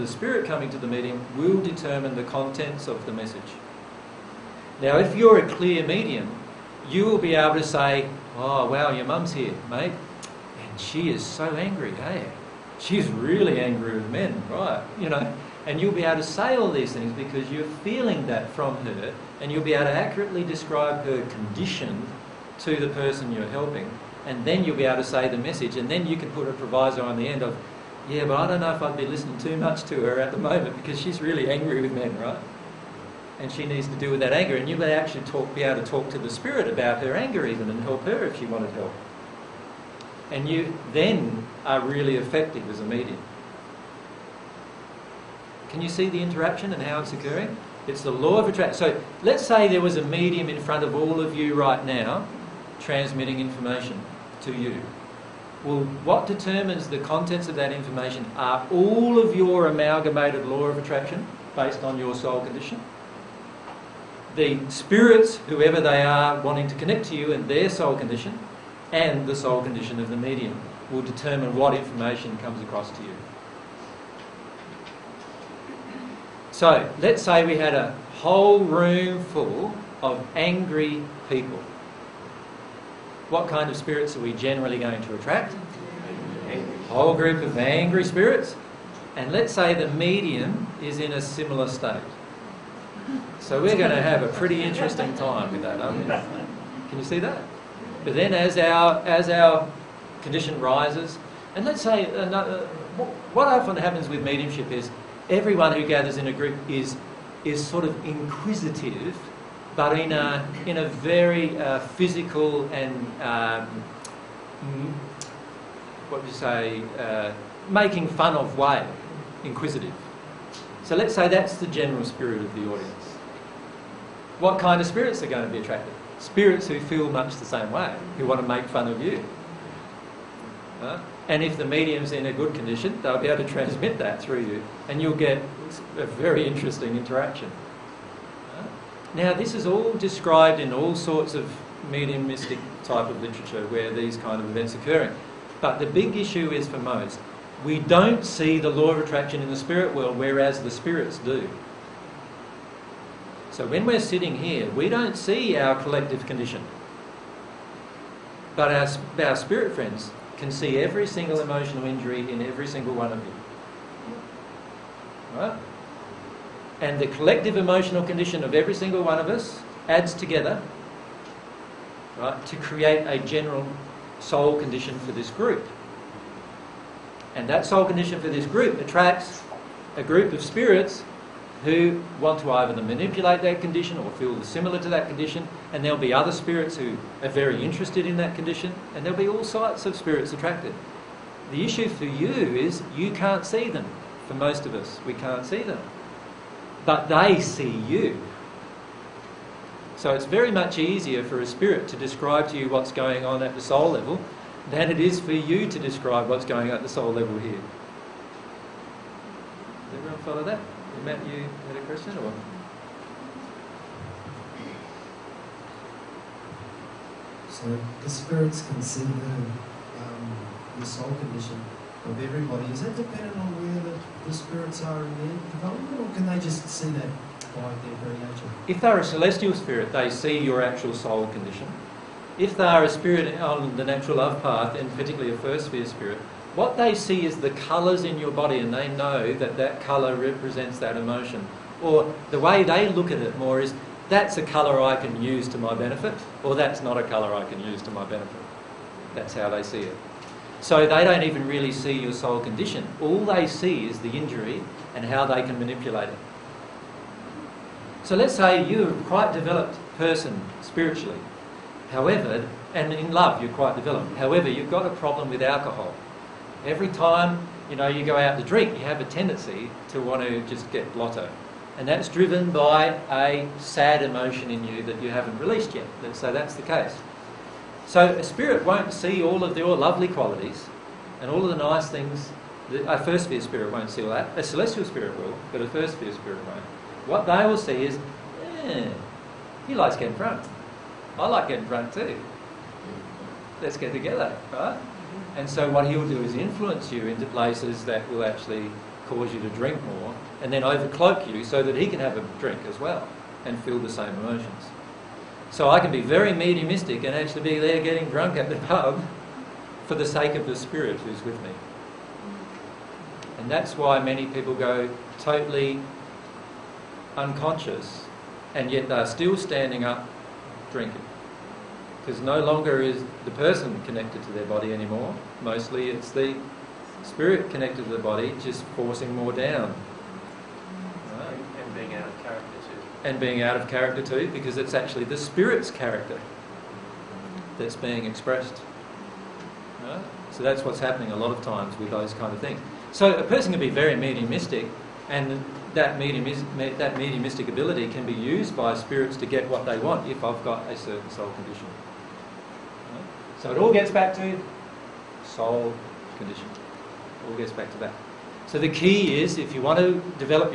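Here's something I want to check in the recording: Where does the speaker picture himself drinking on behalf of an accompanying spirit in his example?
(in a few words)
The pub.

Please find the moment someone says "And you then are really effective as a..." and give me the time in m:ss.
0:40.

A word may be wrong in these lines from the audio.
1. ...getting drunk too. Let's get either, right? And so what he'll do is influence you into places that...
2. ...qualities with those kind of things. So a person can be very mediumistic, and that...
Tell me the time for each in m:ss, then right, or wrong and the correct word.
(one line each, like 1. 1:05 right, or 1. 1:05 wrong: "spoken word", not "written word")
1. 4:51 wrong: "together", not "either"
2. 5:41 wrong: "times", not "qualities".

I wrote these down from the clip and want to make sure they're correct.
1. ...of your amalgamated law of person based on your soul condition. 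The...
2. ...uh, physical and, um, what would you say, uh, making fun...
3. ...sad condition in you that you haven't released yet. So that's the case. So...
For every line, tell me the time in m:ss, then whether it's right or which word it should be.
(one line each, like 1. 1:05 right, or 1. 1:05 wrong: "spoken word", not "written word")
1. 0:59 wrong: "attraction", not "person"
2. 1:51 right
3. 4:33 wrong: "emotion", not "condition".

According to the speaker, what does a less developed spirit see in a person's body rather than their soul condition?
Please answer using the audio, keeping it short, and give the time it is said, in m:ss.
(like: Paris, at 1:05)
Colours, at 3:57.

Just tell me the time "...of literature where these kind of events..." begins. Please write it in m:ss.
2:23.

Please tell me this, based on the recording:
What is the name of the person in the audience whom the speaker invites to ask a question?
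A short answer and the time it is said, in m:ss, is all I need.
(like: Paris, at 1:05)
Matt, at 3:31.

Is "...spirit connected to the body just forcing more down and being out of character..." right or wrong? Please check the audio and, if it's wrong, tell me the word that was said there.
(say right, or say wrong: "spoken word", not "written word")
right.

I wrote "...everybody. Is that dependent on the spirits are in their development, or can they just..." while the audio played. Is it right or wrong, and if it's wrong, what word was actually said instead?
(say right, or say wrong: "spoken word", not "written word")
right.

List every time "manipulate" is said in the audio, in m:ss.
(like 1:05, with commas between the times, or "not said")
3:02, 4:15.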